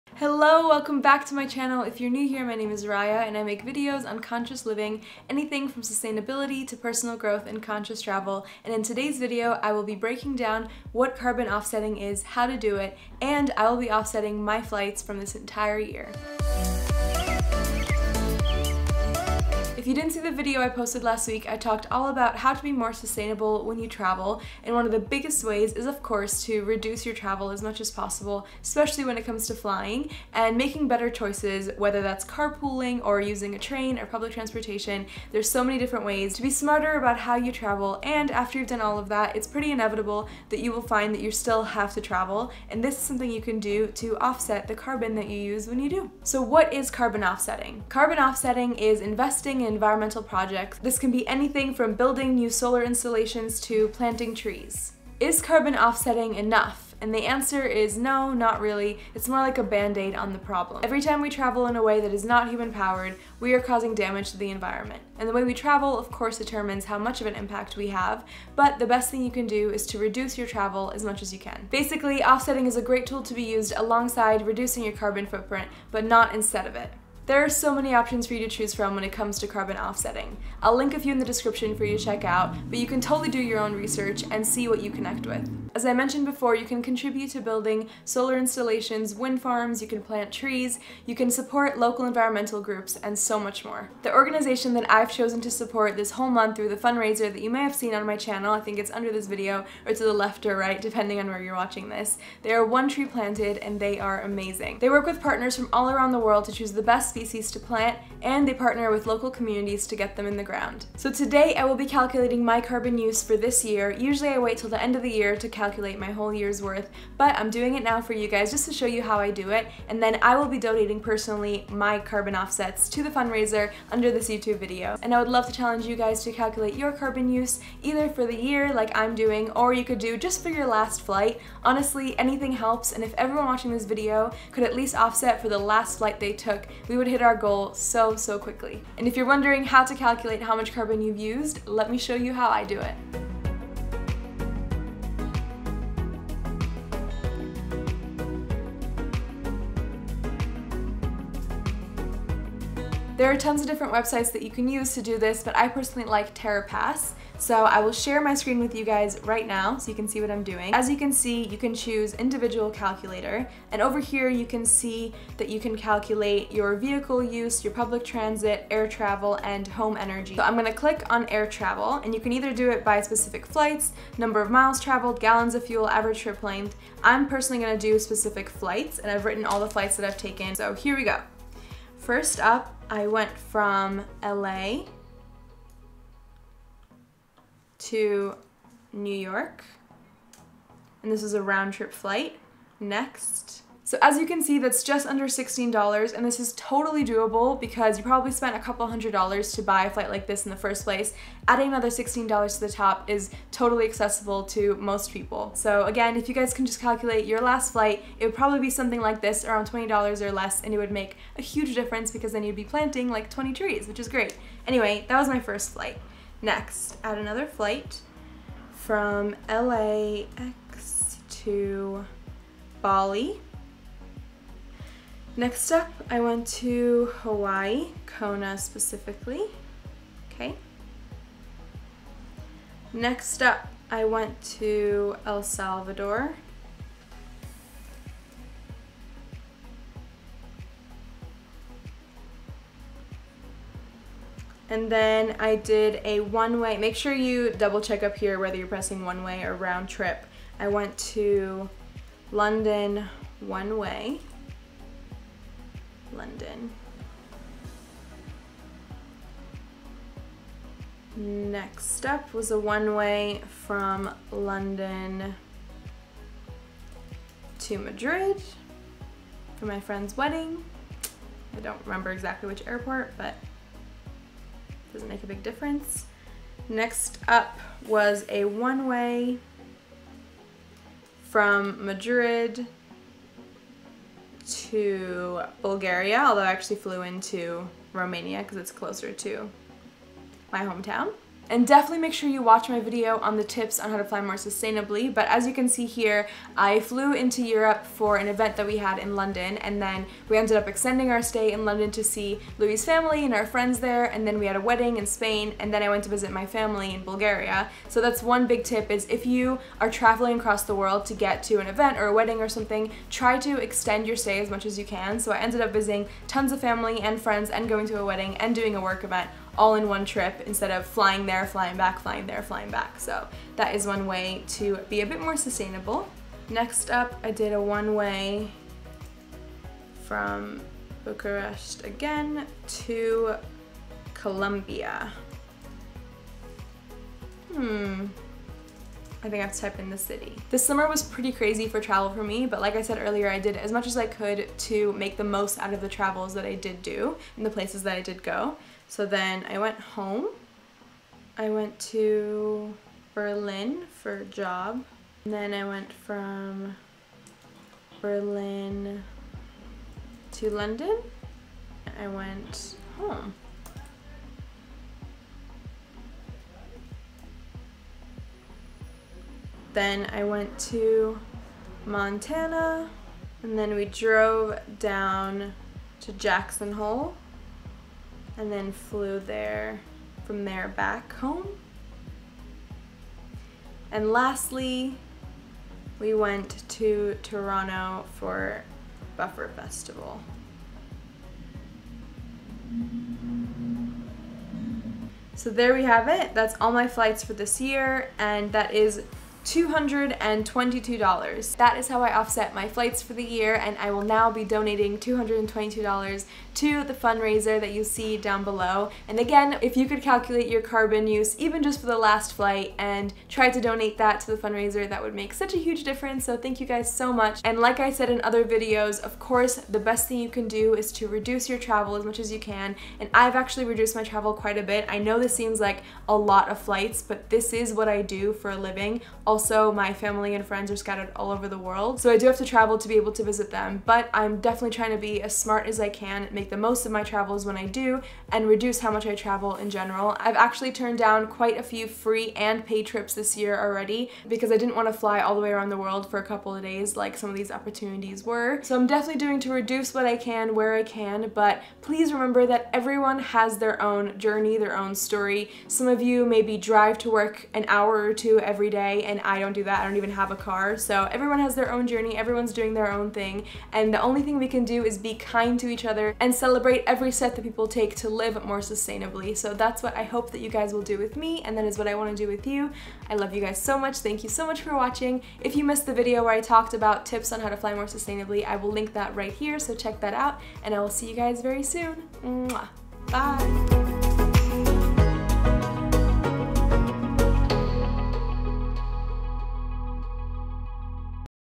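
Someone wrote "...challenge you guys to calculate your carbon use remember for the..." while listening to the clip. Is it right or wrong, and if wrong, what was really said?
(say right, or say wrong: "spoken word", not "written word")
wrong: "either", not "remember".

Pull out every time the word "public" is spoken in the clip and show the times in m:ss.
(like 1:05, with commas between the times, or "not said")
0:34, 2:47.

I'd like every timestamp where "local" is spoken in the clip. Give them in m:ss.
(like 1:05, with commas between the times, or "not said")
1:31, 1:49.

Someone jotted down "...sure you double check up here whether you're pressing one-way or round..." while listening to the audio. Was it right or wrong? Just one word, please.
right.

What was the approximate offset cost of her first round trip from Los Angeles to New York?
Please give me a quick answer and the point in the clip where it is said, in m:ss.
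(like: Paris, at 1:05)
just under $16, at 3:14.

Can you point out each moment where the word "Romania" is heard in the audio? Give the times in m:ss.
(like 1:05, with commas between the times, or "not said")
4:47.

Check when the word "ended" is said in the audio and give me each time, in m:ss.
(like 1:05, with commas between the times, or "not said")
5:00, 5:15.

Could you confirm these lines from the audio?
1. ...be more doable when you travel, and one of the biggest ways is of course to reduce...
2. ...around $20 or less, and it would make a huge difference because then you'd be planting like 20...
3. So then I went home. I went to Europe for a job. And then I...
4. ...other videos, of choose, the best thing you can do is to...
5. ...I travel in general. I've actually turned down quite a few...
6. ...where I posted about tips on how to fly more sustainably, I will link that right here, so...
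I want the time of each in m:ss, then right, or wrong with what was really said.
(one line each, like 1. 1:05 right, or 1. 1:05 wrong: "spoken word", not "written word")
1. 0:22 wrong: "sustainable", not "doable"
2. 3:29 right
3. 5:48 wrong: "Berlin", not "Europe"
4. 6:58 wrong: "course", not "choose"
5. 7:19 right
6. 7:56 wrong: "talked", not "posted".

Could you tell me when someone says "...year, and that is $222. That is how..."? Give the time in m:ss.
6:37.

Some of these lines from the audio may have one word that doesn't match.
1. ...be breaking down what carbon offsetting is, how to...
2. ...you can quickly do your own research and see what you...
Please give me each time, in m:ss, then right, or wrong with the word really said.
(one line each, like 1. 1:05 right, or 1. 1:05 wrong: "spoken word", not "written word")
1. 0:09 right
2. 1:22 wrong: "totally", not "quickly".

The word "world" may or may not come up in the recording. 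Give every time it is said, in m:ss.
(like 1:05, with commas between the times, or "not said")
1:46, 5:10, 7:11, 7:25.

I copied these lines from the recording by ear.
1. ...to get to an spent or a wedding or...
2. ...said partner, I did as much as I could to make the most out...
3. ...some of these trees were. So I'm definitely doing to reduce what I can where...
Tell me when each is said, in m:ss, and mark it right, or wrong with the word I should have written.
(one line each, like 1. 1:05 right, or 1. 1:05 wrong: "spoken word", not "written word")
1. 5:11 wrong: "event", not "spent"
2. 5:42 wrong: "earlier", not "partner"
3. 7:27 wrong: "opportunities", not "trees".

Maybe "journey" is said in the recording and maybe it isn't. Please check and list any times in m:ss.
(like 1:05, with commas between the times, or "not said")
7:34, 7:41.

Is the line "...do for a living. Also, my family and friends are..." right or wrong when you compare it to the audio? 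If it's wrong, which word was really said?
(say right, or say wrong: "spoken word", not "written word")
right.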